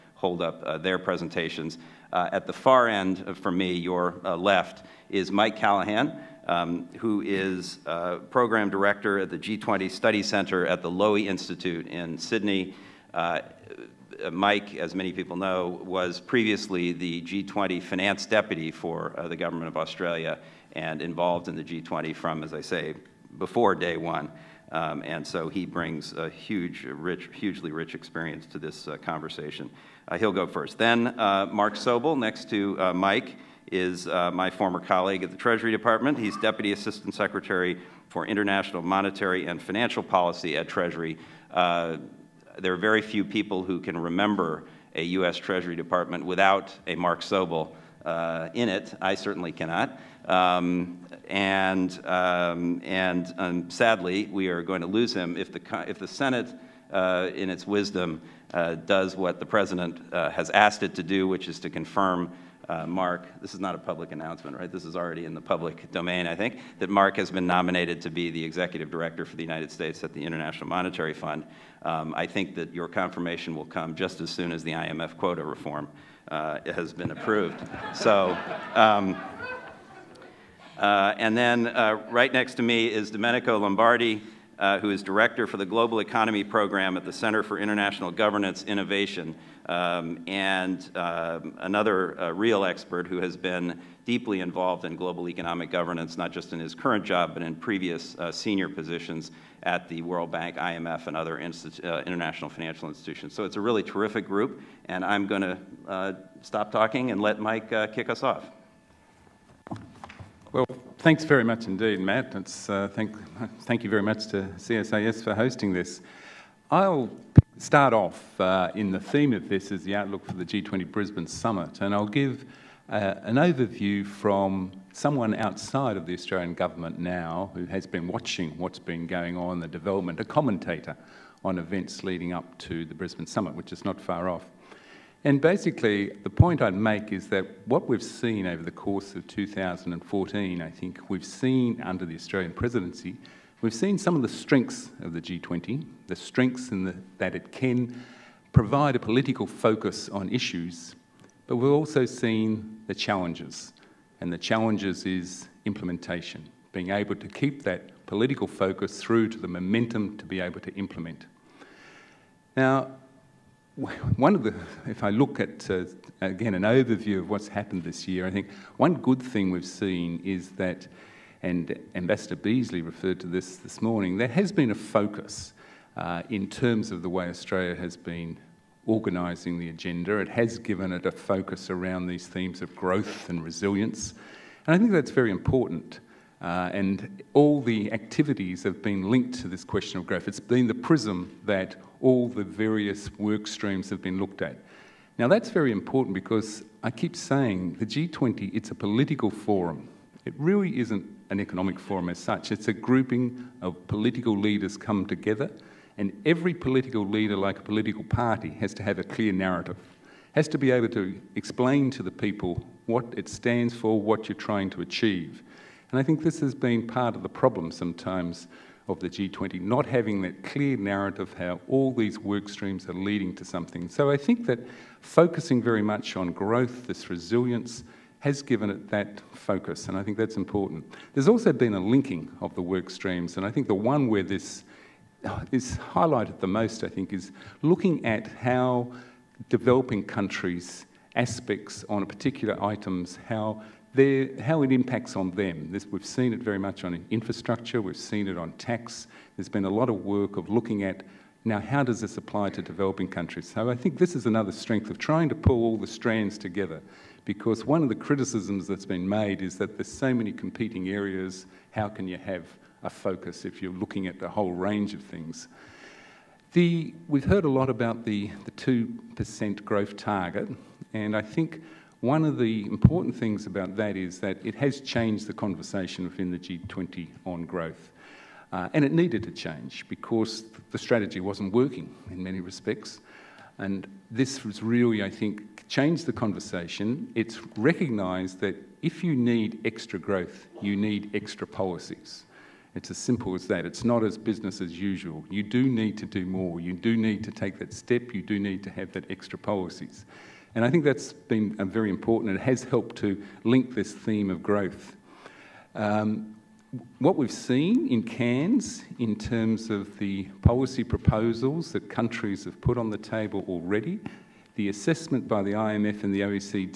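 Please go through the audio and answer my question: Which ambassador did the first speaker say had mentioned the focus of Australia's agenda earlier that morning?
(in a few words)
Ambassador Beazley.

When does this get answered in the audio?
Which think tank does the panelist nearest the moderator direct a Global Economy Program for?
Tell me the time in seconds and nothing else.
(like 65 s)
87 s.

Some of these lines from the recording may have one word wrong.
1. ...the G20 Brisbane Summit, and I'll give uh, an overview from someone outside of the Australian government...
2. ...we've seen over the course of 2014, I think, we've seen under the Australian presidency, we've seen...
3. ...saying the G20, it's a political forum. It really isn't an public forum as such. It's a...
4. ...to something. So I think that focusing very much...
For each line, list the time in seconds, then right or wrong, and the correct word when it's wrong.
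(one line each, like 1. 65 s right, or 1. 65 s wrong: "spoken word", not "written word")
1. 120 s right
2. 137 s right
3. 197 s wrong: "economic", not "public"
4. 223 s right.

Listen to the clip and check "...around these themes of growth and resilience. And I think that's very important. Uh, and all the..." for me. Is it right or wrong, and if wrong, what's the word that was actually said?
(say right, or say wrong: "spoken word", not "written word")
right.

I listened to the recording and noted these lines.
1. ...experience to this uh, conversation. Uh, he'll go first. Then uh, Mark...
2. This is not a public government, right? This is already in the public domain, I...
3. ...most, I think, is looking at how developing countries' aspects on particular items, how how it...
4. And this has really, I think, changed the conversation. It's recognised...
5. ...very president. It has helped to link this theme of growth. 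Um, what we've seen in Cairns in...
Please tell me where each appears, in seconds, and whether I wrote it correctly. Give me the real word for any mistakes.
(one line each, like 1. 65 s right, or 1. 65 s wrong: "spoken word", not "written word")
1. 27 s right
2. 63 s wrong: "announcement", not "government"
3. 236 s right
4. 283 s right
5. 301 s wrong: "important", not "president".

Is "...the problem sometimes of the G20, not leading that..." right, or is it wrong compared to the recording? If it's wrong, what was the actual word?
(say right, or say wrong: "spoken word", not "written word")
wrong: "having", not "leading".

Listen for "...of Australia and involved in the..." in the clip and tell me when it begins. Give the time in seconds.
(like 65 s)
19 s.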